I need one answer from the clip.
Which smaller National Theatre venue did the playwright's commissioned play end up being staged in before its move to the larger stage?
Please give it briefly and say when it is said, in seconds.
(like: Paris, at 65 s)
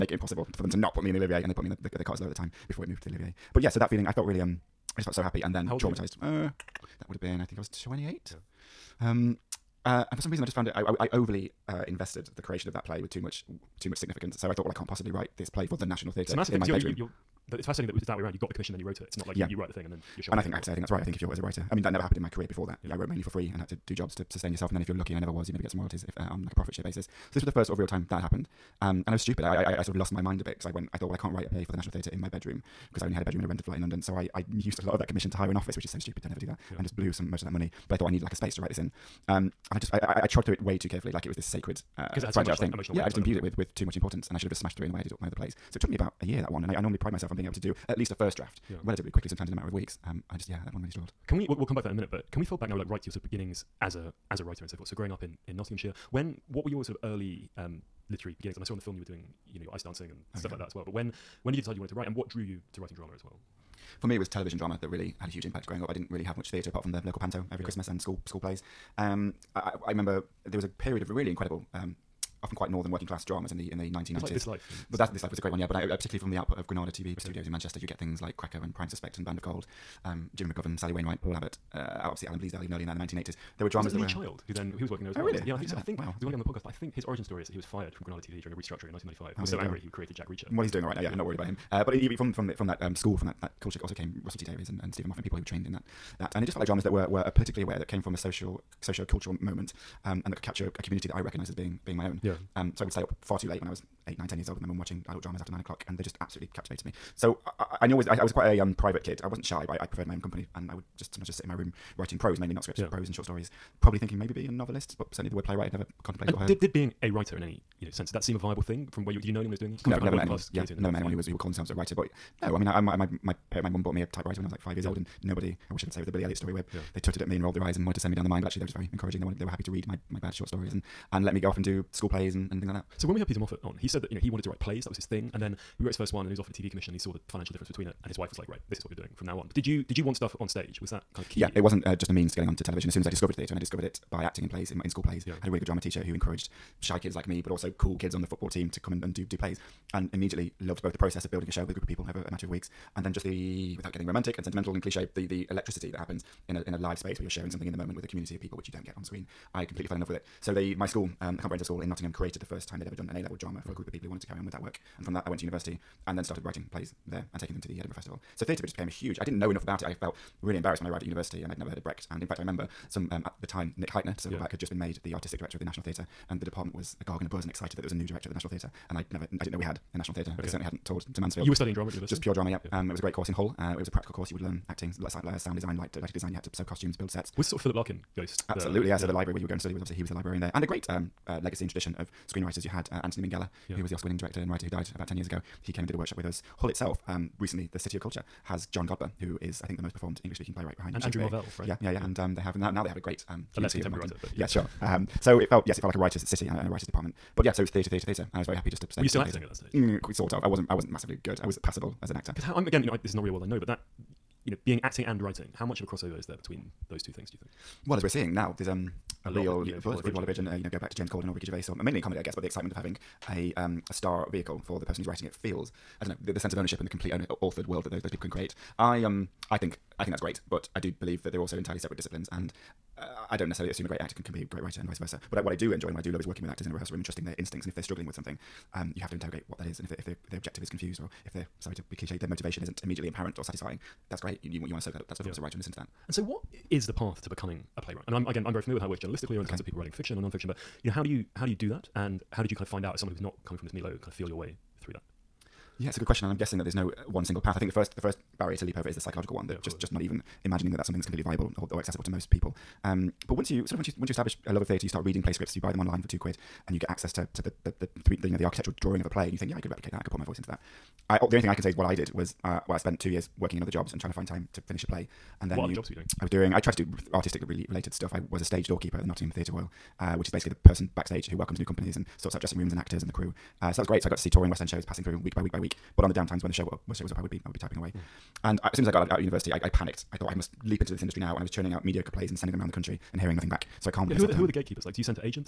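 The Cottesloe, at 2 s.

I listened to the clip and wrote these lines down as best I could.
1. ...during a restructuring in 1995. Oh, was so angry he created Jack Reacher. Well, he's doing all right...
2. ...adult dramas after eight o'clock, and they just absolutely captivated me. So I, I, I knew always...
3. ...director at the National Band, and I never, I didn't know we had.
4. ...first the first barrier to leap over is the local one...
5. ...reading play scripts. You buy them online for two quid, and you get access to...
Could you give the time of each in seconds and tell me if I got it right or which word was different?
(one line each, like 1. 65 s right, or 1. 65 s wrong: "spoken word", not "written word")
1. 88 s right
2. 105 s wrong: "nine", not "eight"
3. 178 s wrong: "Theatre", not "Band"
4. 257 s wrong: "psychological", not "local"
5. 265 s right.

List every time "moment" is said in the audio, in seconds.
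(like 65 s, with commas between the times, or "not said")
99 s, 157 s.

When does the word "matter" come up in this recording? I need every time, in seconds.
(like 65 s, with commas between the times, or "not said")
49 s, 152 s.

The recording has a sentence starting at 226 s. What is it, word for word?
I don't know the, the sense of ownership and the complete owner, authored world that those those people can create.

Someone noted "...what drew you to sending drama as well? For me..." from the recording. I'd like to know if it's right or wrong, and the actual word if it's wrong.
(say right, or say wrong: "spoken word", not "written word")
wrong: "writing", not "sending".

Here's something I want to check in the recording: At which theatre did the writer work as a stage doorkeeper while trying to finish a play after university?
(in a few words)
Nottingham Theatre Royal.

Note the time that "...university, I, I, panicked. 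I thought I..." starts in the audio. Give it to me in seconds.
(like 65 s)
289 s.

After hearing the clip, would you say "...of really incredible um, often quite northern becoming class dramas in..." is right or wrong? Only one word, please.
wrong.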